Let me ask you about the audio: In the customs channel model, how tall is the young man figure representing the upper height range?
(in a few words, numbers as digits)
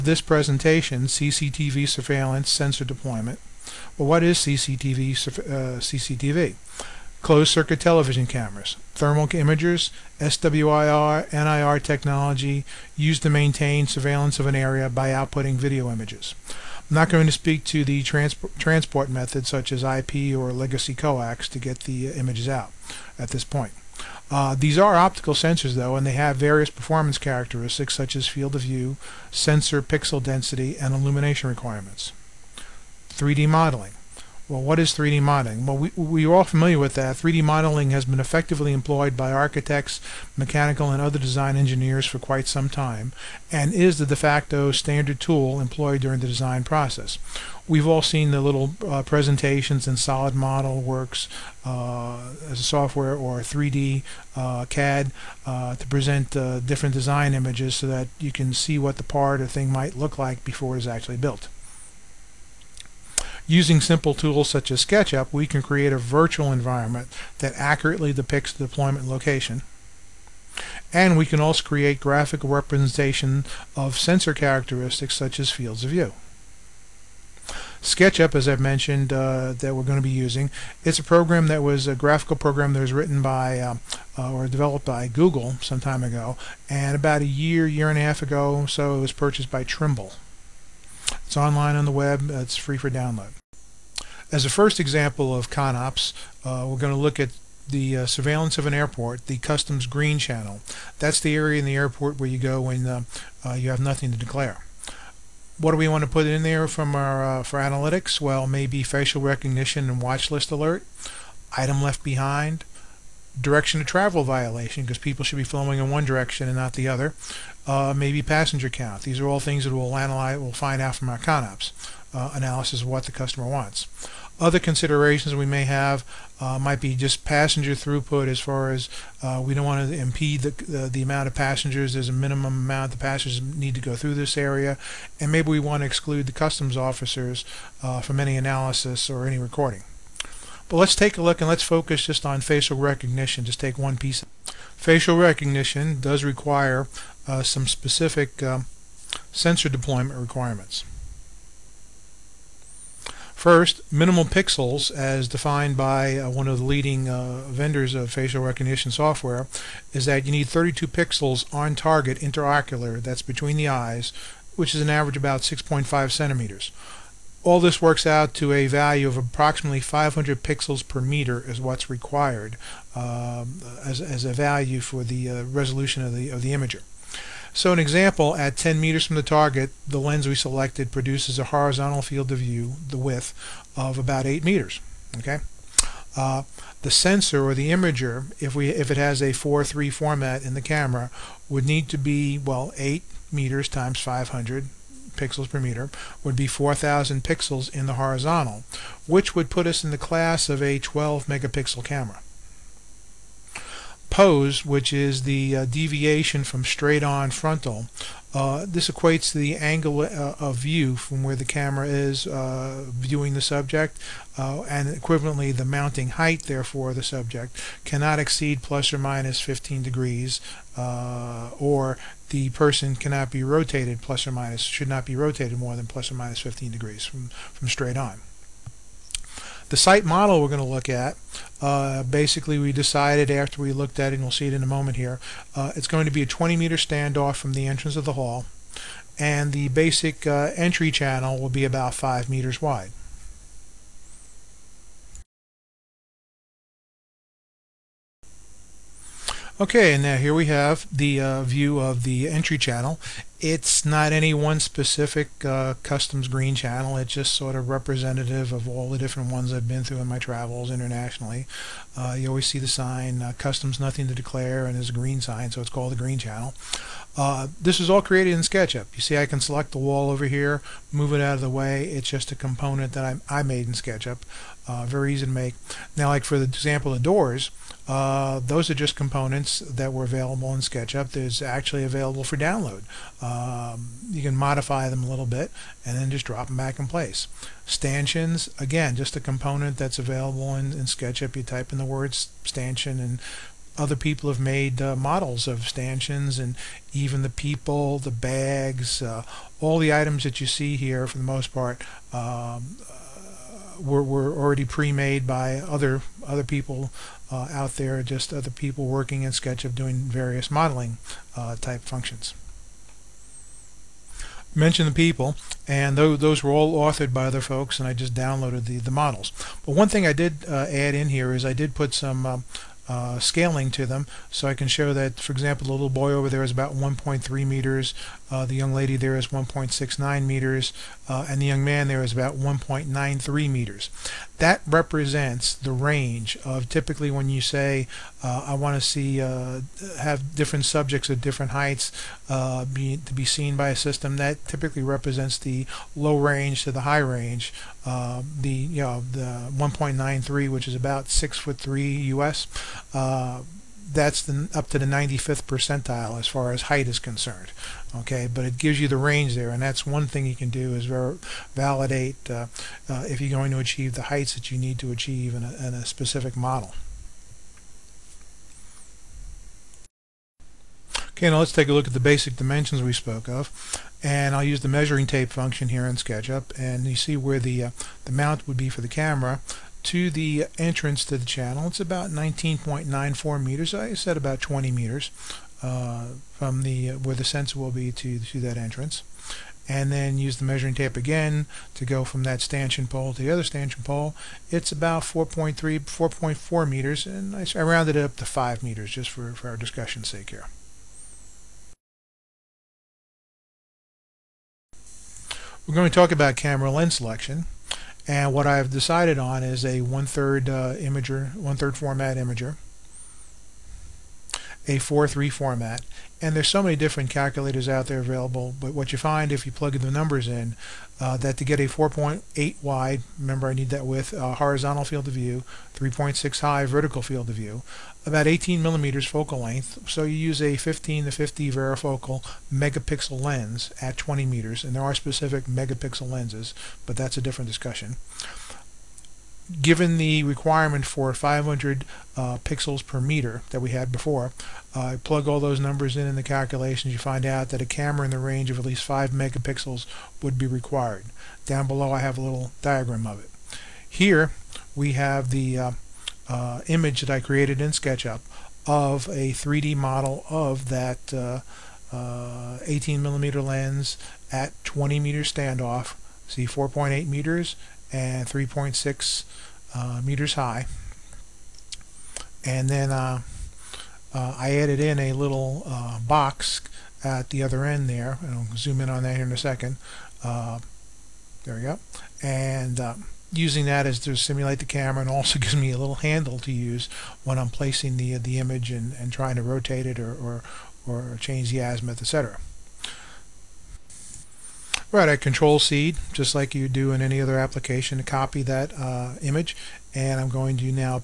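1.93 meters.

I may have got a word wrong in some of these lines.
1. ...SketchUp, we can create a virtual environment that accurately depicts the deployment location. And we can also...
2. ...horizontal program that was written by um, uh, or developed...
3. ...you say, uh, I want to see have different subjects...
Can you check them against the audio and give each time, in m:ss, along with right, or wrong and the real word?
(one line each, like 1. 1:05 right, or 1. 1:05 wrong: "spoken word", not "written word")
1. 1:04 right
2. 1:21 wrong: "graphical", not "horizontal"
3. 5:37 right.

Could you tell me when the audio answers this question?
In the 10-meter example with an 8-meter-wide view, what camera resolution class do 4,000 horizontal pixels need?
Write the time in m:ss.
3:20.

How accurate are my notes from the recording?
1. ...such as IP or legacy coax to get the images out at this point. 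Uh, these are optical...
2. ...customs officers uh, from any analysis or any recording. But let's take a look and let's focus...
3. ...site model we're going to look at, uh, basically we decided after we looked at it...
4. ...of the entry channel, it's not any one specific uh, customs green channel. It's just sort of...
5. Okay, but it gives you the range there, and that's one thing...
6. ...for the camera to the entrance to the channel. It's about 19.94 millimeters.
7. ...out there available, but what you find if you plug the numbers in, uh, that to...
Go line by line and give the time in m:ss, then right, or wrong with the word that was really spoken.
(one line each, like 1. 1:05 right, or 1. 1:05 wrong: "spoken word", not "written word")
1. 0:19 right
2. 2:16 right
3. 3:49 right
4. 4:11 right
5. 5:57 right
6. 6:18 wrong: "meters", not "millimeters"
7. 6:57 right.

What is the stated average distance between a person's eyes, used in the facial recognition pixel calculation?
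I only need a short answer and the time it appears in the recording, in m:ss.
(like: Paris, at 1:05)
6.5 centimeters, at 2:45.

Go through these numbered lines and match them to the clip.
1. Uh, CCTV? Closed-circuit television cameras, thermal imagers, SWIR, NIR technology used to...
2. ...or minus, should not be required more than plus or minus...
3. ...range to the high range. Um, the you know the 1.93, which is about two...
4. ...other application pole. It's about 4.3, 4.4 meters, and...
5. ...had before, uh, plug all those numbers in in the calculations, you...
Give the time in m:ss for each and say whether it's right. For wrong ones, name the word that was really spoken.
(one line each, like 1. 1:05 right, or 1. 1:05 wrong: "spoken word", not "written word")
1. 0:05 right
2. 3:44 wrong: "rotated", not "required"
3. 5:46 wrong: "six", not "two"
4. 6:33 wrong: "stanchion", not "application"
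5. 7:23 right.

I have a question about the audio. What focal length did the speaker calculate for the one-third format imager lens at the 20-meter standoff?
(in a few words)
18 millimeters.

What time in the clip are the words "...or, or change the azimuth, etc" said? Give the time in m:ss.
8:10.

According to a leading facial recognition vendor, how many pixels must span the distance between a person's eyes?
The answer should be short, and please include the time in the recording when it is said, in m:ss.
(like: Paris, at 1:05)
32, at 2:40.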